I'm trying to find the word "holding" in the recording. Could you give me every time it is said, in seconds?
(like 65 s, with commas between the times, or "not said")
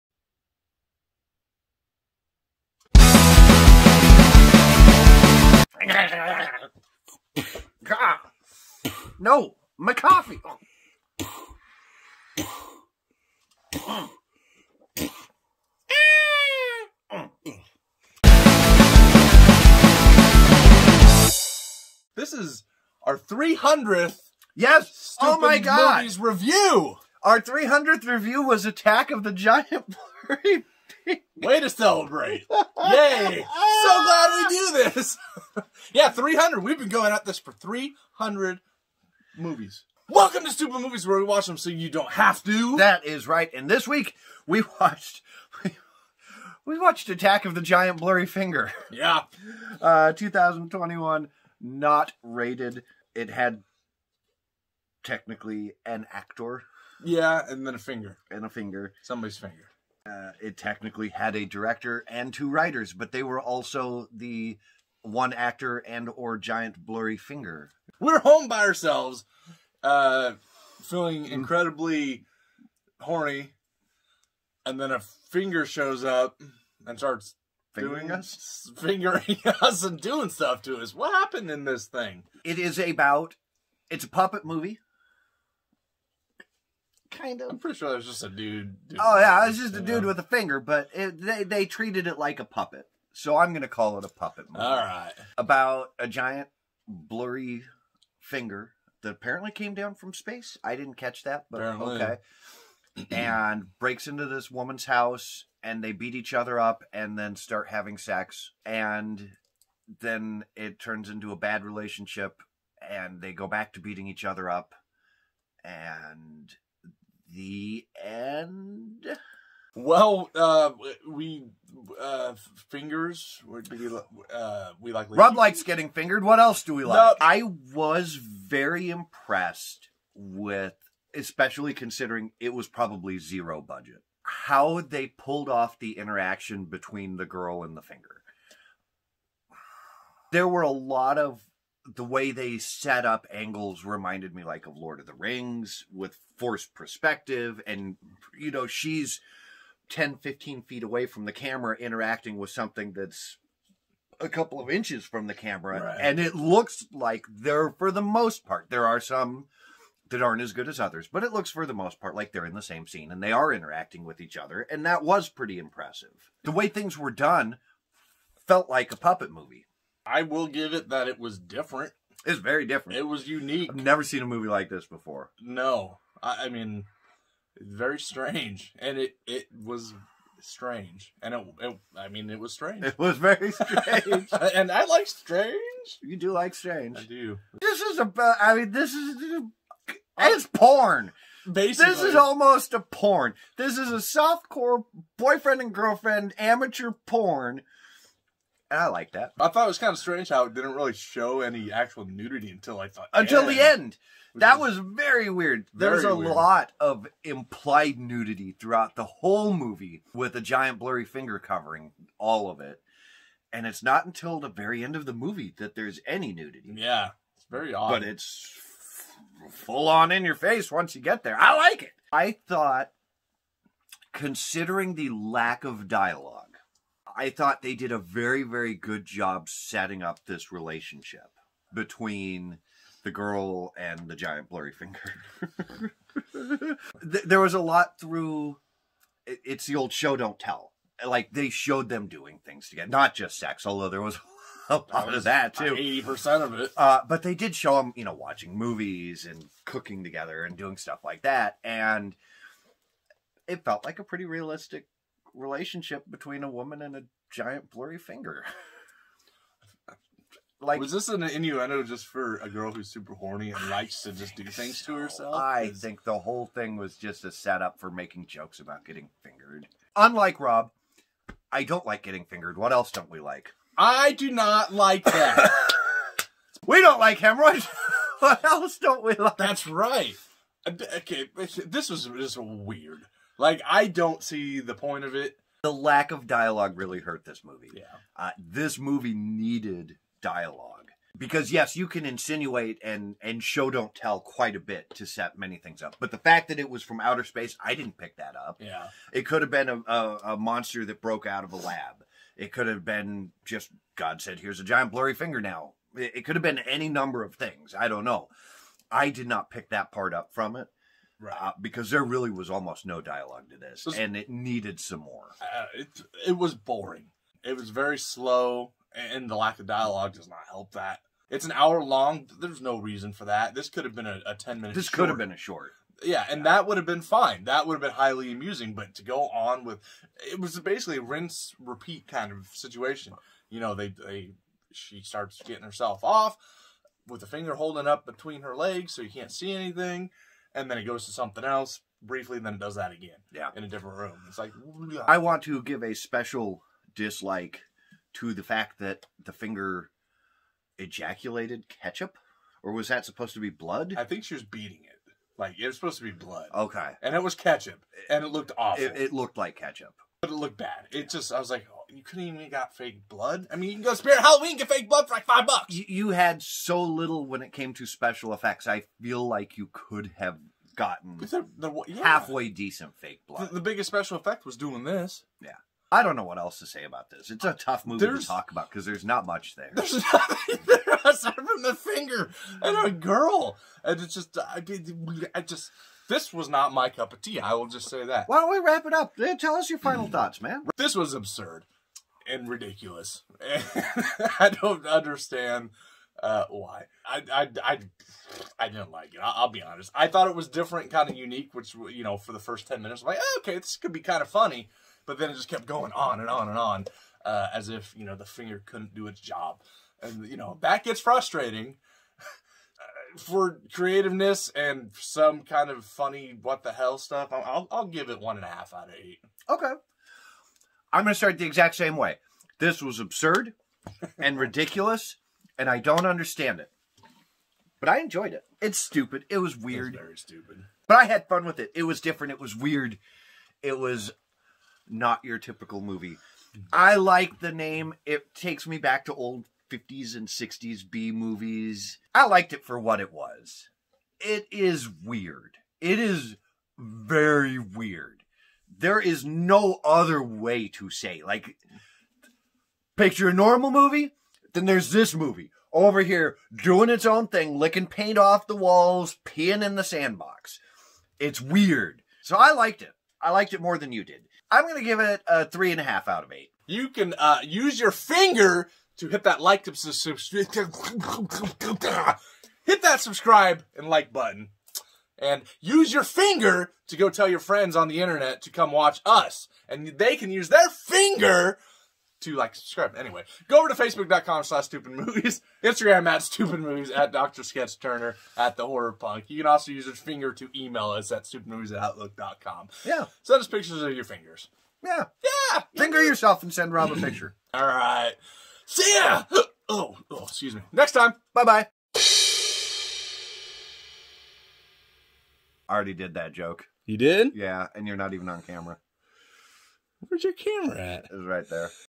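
337 s.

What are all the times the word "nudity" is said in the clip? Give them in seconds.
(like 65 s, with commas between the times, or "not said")
202 s, 207 s, 216 s.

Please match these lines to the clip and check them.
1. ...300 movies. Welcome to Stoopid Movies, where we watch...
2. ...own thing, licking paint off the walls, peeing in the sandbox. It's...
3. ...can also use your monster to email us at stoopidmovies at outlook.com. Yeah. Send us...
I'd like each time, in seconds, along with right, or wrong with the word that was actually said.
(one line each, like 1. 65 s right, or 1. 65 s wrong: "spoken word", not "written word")
1. 37 s right
2. 457 s right
3. 489 s wrong: "finger", not "monster".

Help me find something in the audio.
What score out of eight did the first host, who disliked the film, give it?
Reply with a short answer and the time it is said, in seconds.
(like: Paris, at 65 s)
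1.5, at 418 s.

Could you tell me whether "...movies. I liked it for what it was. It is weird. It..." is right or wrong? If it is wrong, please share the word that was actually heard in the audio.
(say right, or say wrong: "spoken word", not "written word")
right.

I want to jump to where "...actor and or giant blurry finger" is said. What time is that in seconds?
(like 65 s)
65 s.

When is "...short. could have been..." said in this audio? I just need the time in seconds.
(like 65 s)
324 s.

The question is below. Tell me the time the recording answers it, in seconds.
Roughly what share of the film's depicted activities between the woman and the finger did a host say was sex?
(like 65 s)
245 s.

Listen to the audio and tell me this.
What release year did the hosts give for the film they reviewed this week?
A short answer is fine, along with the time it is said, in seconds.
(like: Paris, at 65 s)
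2021, at 50 s.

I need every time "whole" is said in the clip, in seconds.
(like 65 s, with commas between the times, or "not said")
209 s, 266 s.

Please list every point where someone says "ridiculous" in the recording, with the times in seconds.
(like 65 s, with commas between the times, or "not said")
392 s, 424 s.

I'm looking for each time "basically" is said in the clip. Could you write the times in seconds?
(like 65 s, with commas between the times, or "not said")
191 s, 330 s.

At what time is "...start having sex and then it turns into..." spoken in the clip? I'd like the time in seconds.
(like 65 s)
107 s.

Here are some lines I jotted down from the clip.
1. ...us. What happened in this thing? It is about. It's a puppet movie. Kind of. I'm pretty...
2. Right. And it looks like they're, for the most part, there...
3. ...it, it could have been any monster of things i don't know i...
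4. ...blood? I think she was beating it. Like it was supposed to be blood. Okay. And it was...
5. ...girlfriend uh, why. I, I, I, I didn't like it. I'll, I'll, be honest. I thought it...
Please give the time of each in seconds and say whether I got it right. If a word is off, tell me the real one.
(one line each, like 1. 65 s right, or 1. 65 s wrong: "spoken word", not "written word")
1. 80 s right
2. 155 s right
3. 305 s wrong: "number", not "monster"
4. 353 s right
5. 394 s wrong: "understand", not "girlfriend".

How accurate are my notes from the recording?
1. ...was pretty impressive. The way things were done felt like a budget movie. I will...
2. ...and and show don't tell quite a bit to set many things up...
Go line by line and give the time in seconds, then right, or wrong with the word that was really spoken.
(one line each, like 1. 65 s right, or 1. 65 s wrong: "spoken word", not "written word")
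1. 165 s wrong: "puppet", not "budget"
2. 292 s right.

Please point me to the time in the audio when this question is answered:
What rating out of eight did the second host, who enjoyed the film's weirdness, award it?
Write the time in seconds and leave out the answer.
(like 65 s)
465 s.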